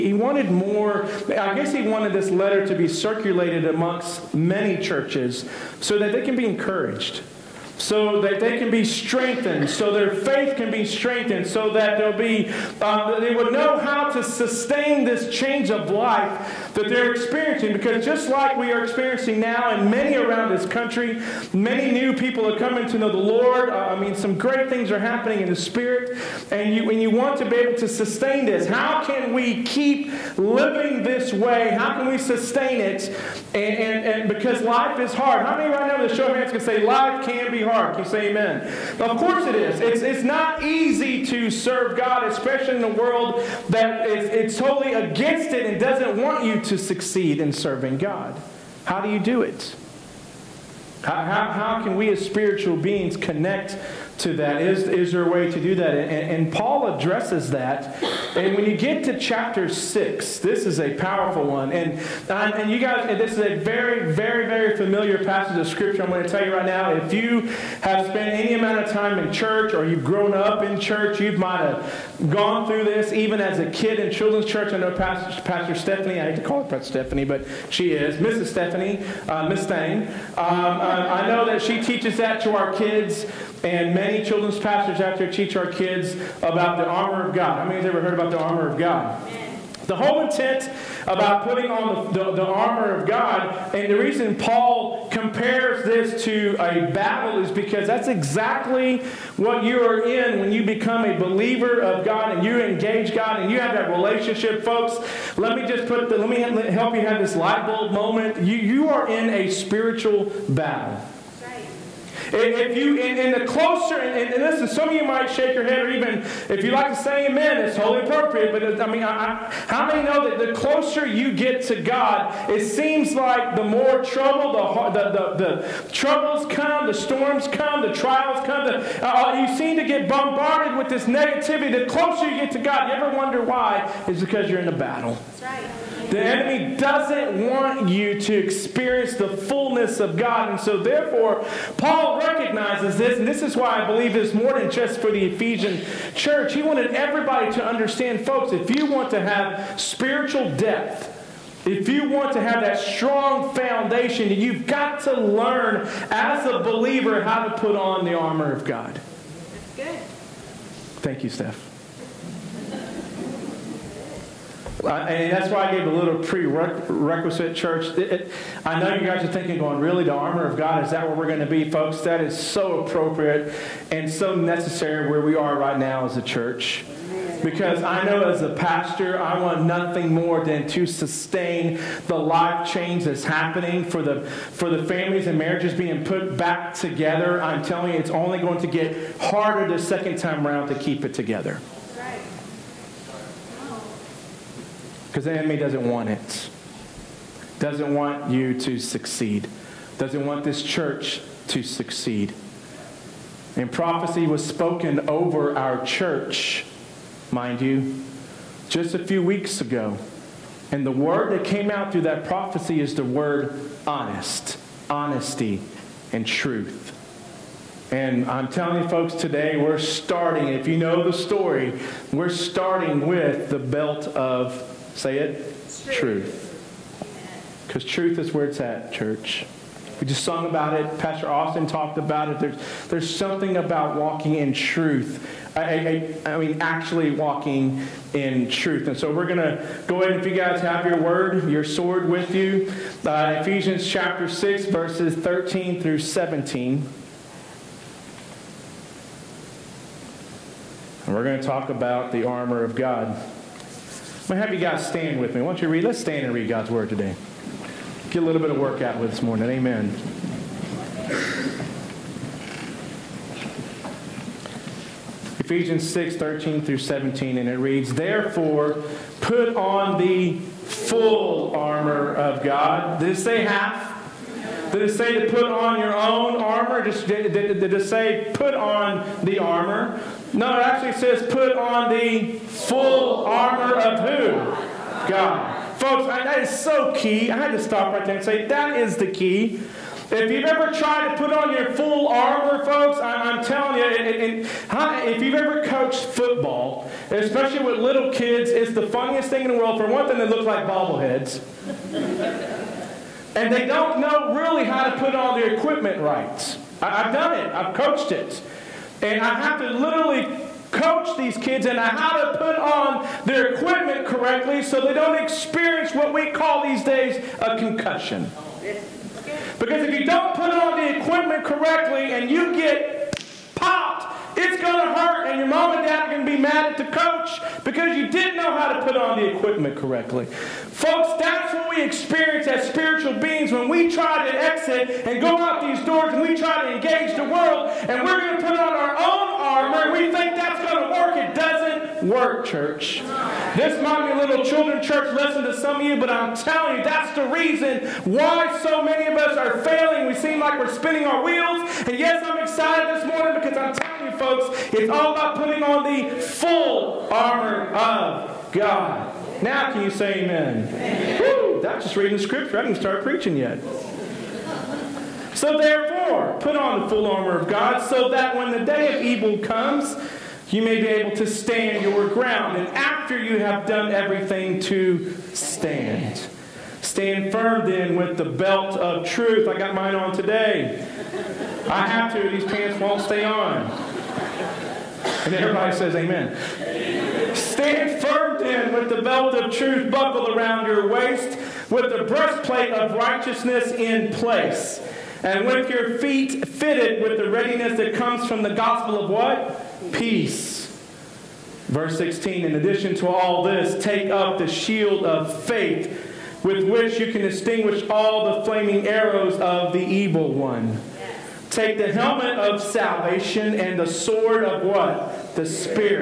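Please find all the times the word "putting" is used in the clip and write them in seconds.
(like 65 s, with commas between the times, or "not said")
91 s, 355 s.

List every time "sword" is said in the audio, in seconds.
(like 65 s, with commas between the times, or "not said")
241 s, 413 s.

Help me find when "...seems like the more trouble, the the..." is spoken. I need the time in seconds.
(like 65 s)
122 s.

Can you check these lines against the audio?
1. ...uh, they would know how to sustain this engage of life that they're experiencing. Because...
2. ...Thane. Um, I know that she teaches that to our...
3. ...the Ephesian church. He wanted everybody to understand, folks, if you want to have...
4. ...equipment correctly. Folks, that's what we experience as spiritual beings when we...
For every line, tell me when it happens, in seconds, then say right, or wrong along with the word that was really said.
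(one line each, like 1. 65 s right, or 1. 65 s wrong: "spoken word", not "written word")
1. 12 s wrong: "change", not "engage"
2. 79 s right
3. 145 s right
4. 329 s right.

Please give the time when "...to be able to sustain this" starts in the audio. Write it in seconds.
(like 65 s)
27 s.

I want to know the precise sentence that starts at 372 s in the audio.
And after you have done everything to stand, stand firm then with the belt of truth.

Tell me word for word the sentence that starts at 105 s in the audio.
Let me just put the, let me help you have this light bulb moment.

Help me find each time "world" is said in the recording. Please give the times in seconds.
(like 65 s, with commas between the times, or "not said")
42 s, 299 s, 337 s.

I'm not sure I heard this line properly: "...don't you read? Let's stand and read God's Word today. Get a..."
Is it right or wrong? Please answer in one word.
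right.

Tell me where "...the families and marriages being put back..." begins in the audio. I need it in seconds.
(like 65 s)
184 s.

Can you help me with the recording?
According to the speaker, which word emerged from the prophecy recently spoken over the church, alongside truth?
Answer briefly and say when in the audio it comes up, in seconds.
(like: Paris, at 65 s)
Honesty, at 214 s.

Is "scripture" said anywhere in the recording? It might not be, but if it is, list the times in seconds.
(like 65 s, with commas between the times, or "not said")
65 s, 362 s.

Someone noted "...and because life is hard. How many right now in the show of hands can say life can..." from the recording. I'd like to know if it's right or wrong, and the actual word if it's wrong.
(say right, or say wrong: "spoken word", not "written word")
right.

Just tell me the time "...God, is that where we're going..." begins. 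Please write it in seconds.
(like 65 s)
170 s.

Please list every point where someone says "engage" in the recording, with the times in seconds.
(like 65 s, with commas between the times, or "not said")
102 s, 336 s.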